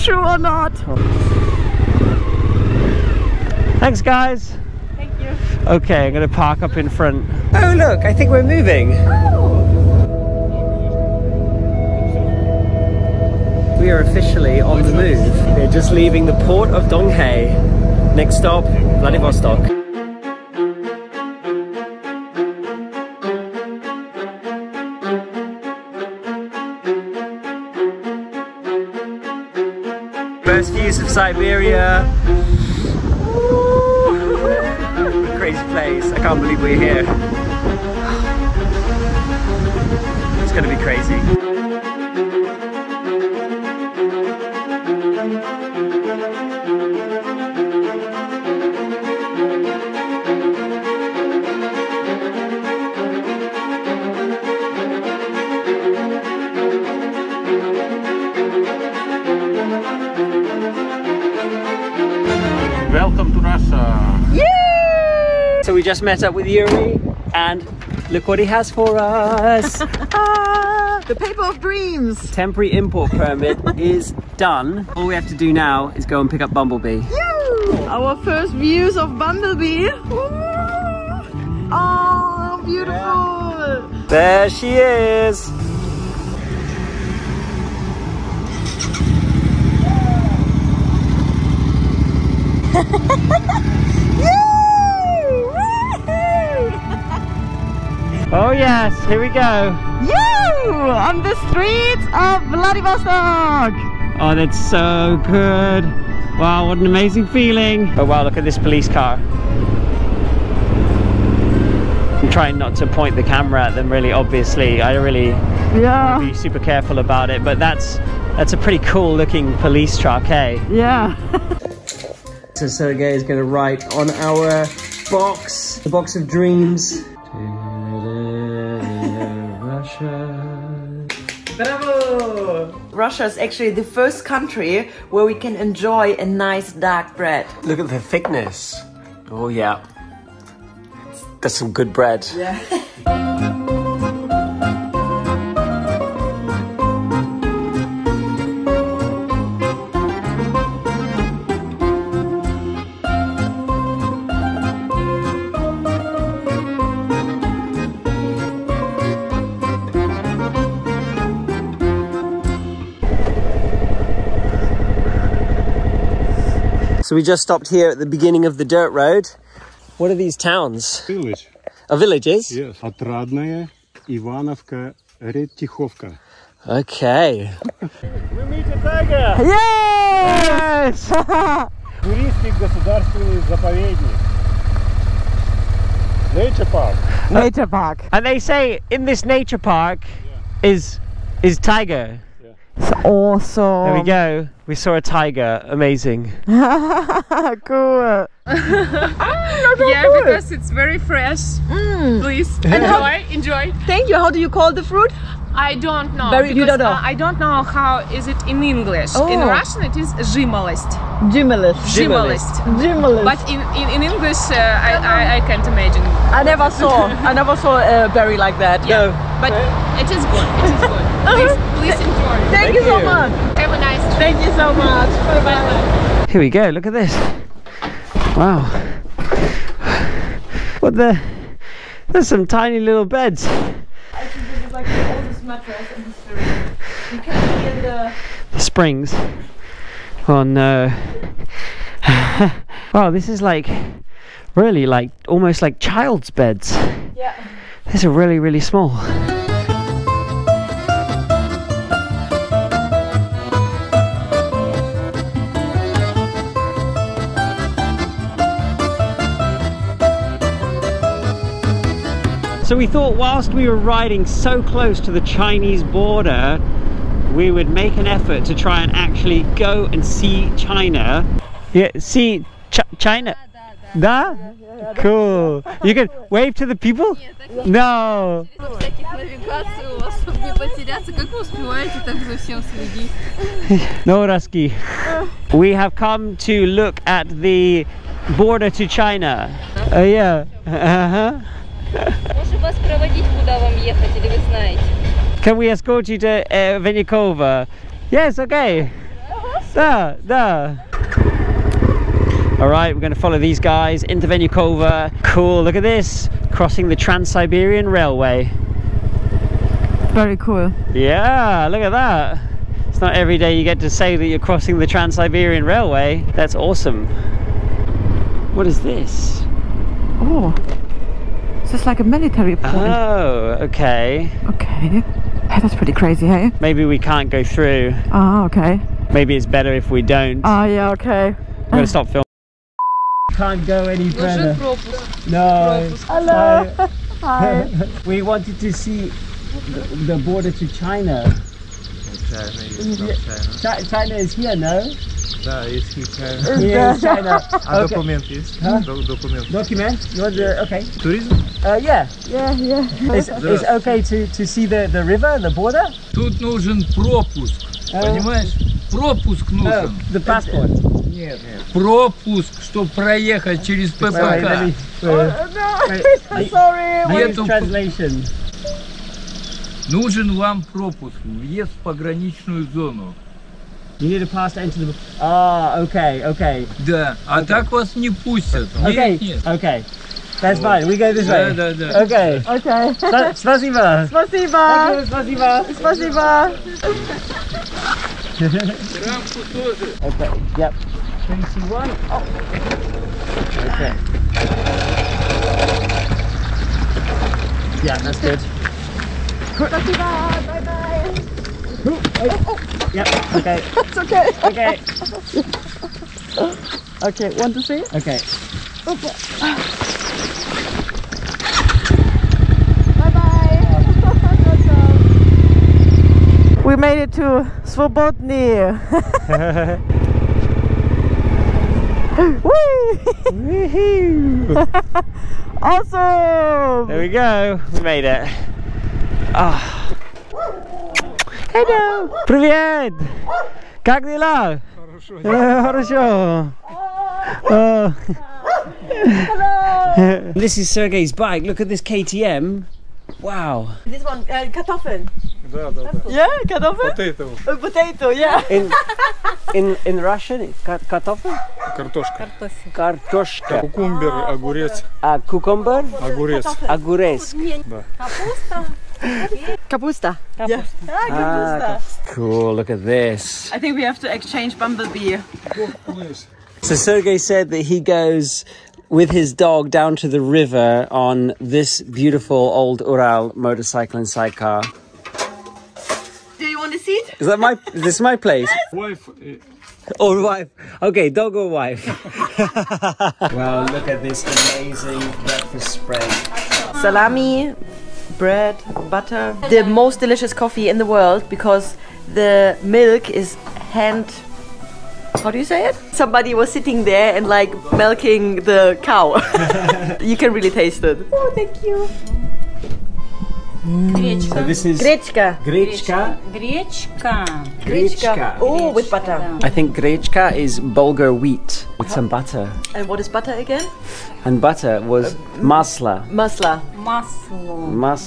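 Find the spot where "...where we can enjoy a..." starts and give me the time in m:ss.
2:15.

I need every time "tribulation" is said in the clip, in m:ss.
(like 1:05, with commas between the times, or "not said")
not said.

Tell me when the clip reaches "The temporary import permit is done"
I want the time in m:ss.
1:12.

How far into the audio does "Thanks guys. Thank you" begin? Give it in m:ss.
0:03.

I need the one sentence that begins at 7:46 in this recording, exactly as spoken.
so Sergey said that he goes with his dog down to the river on this beautiful old Ural motorcycle and sidecar.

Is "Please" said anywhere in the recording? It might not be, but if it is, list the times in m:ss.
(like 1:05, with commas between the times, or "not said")
3:22, 3:41.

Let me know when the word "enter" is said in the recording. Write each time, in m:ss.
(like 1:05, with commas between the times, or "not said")
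6:14.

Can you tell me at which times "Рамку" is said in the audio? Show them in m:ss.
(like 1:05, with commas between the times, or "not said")
6:29.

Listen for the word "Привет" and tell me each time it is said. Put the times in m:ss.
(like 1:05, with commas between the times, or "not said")
7:12.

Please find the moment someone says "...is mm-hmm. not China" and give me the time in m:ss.
5:42.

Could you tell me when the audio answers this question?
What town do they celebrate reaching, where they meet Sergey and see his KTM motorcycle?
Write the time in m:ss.
6:57.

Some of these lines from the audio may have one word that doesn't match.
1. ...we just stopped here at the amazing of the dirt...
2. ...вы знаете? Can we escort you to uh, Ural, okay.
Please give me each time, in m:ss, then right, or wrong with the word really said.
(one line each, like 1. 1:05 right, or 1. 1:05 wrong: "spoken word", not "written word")
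1. 2:47 wrong: "beginning", not "amazing"
2. 4:54 wrong: "Yes", not "Ural".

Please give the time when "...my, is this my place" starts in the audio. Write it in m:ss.
7:57.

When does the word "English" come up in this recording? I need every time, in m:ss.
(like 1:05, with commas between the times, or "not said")
3:28, 3:34.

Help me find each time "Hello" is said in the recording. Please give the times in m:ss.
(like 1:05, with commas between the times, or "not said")
5:36, 7:11, 7:17.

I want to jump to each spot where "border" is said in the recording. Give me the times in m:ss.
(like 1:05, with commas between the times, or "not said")
4:25, 4:48, 5:40, 5:55.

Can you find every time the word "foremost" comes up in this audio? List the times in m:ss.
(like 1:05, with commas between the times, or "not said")
not said.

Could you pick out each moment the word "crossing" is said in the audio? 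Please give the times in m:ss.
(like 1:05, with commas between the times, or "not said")
5:06, 5:14.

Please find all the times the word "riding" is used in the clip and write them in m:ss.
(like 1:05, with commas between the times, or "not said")
4:23.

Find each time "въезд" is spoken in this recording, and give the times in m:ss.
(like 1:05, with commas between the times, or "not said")
6:11.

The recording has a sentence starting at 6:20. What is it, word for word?
That's fine, we go this way.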